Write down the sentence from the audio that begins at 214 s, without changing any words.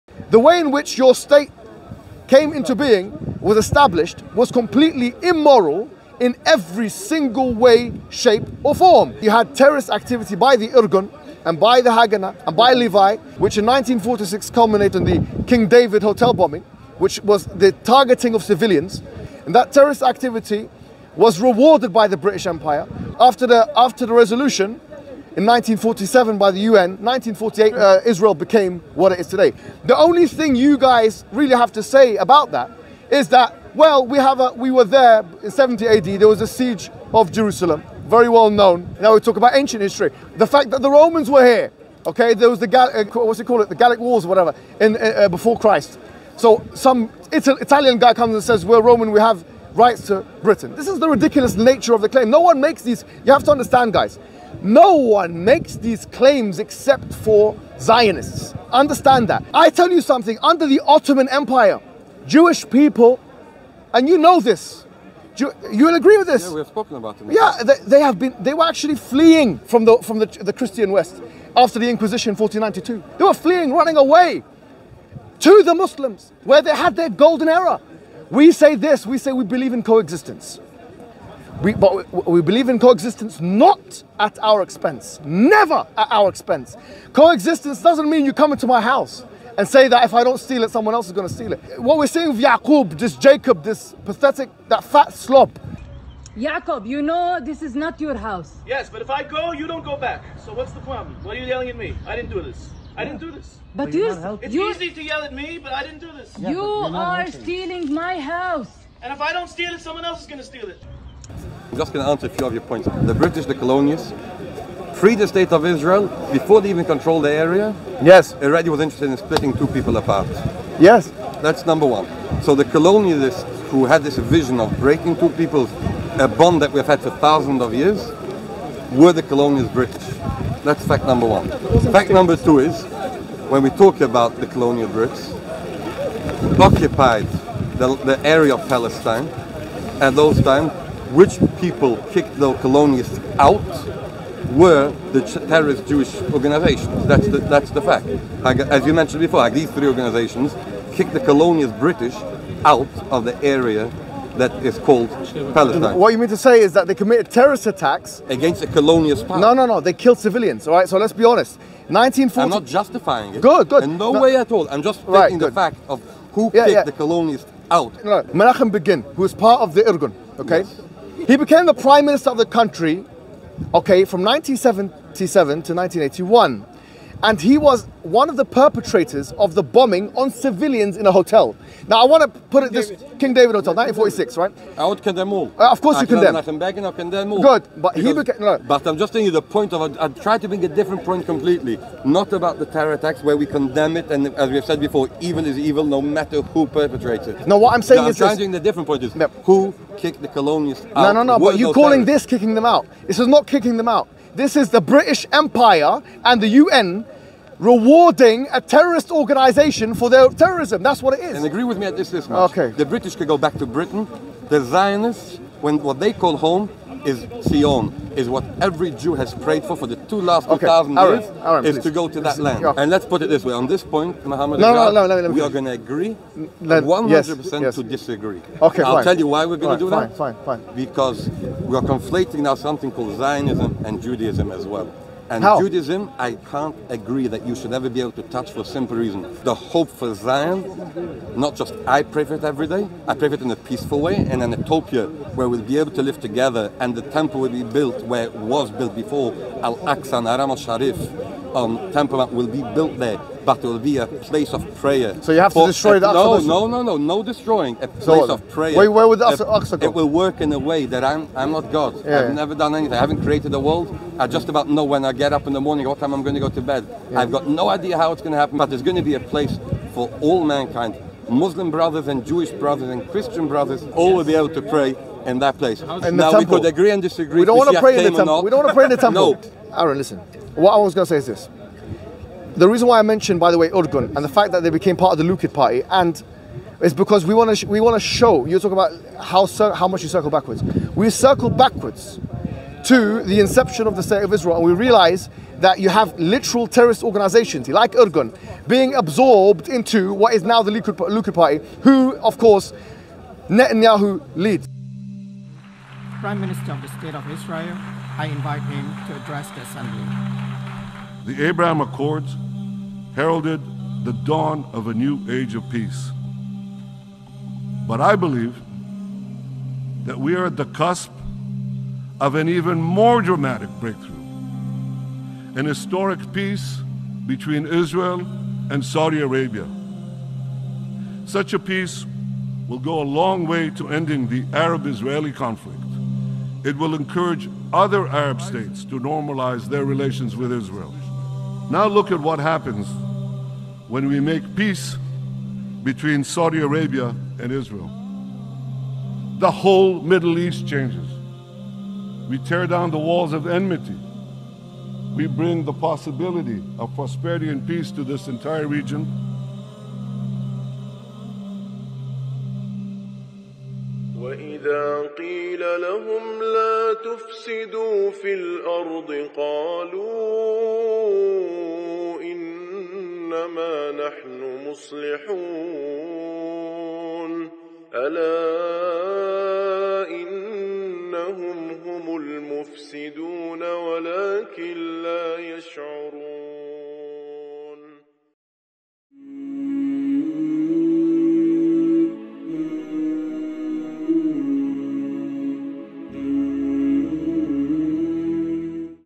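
The Zionists, when what they call home, is Zion, is what every Jew has prayed for for the two last okay.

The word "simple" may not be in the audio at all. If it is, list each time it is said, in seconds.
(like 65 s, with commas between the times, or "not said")
238 s.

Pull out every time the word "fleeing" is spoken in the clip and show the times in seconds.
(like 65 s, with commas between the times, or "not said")
68 s, 73 s.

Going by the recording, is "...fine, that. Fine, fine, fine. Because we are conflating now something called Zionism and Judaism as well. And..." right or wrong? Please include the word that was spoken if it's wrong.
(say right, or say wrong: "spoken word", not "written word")
right.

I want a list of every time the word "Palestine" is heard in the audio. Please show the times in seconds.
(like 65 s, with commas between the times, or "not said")
138 s, 155 s.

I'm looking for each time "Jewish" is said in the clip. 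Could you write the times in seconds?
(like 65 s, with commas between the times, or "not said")
62 s, 145 s, 272 s.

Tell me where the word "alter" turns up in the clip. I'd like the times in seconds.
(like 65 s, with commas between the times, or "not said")
not said.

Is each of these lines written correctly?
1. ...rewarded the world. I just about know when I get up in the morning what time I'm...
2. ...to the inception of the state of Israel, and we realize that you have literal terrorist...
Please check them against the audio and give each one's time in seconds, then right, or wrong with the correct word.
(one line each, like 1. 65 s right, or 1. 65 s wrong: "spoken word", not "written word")
1. 263 s wrong: "created", not "rewarded"
2. 292 s right.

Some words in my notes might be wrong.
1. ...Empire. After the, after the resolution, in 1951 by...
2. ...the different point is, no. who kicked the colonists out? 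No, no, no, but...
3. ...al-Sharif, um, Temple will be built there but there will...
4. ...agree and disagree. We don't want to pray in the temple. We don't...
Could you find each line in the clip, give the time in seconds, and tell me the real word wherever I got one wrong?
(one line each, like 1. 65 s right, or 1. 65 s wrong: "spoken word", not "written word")
1. 22 s wrong: "1947", not "1951"
2. 198 s right
3. 250 s right
4. 276 s right.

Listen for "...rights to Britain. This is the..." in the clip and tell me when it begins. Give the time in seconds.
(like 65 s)
49 s.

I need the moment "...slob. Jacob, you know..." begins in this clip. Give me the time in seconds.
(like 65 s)
95 s.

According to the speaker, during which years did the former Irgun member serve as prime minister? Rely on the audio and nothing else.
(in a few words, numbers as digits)
1977 to 1981.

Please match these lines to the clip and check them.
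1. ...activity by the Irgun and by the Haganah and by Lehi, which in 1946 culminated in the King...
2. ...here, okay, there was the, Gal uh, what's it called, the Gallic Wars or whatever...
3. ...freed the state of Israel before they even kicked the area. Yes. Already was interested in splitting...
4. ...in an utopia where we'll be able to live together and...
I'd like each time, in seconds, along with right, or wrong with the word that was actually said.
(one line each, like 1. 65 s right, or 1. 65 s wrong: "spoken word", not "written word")
1. 9 s right
2. 41 s right
3. 114 s wrong: "controlled", not "kicked"
4. 244 s right.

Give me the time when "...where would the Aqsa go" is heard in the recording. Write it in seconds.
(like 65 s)
258 s.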